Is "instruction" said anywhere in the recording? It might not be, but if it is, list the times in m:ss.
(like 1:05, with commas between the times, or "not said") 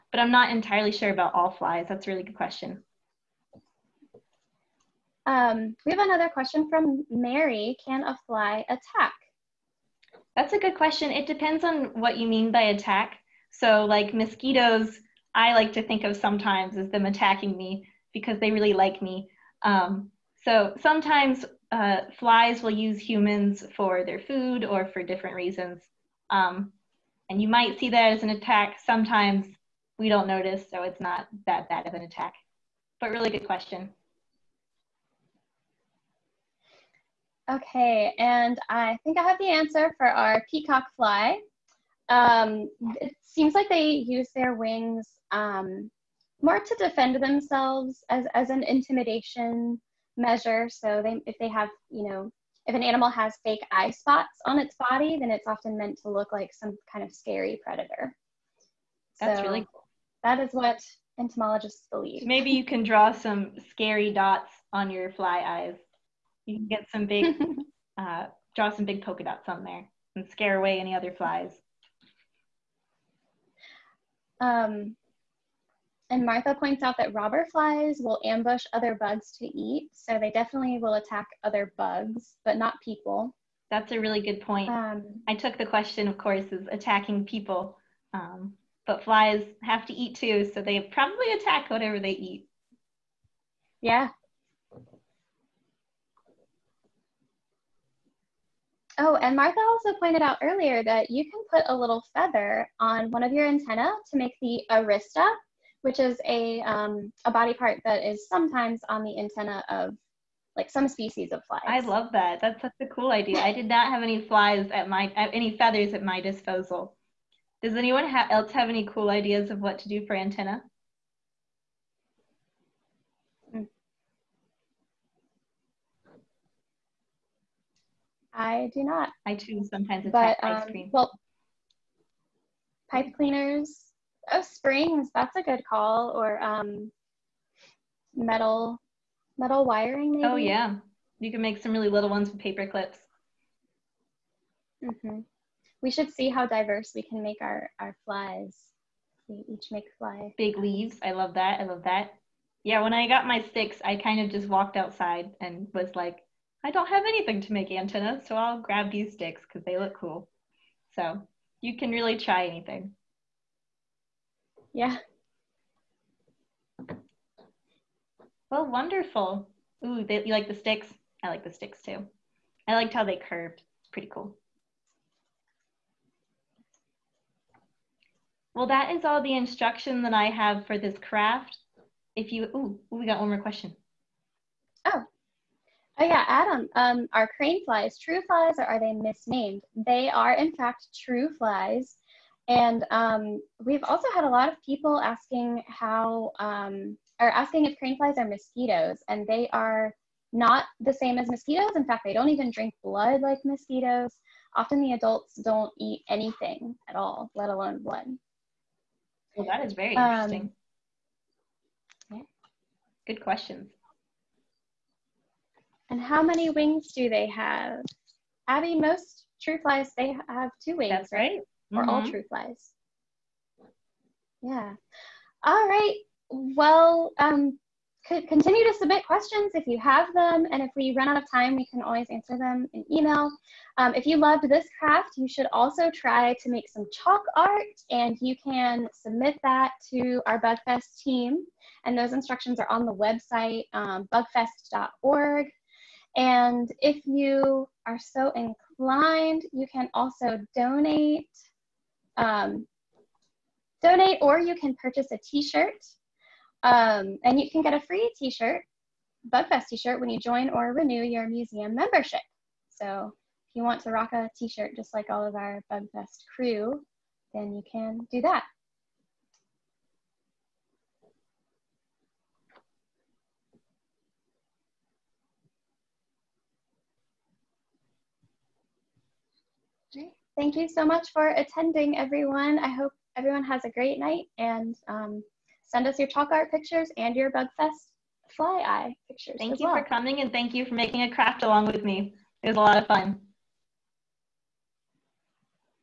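2:59, 4:02.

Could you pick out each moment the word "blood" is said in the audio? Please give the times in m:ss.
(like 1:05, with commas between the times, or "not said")
3:22, 3:27.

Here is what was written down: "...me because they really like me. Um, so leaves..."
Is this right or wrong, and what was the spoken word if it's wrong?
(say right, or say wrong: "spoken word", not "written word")
wrong: "sometimes", not "leaves".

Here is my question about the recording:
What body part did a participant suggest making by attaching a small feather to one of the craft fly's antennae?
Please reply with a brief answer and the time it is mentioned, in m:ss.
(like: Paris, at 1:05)
Arista, at 1:44.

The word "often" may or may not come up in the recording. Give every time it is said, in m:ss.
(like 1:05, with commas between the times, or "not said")
0:55, 3:24.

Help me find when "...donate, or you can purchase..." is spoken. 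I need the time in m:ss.
4:13.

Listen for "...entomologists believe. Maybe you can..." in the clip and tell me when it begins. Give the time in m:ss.
1:01.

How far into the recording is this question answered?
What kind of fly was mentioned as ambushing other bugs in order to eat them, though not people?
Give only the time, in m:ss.
1:17.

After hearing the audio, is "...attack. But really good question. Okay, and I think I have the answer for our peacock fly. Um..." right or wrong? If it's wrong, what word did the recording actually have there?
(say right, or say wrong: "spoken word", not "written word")
right.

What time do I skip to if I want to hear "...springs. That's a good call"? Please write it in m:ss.
2:14.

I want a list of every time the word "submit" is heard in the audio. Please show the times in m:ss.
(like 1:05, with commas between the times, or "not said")
3:48, 3:58.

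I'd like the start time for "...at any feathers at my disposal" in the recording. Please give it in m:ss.
1:55.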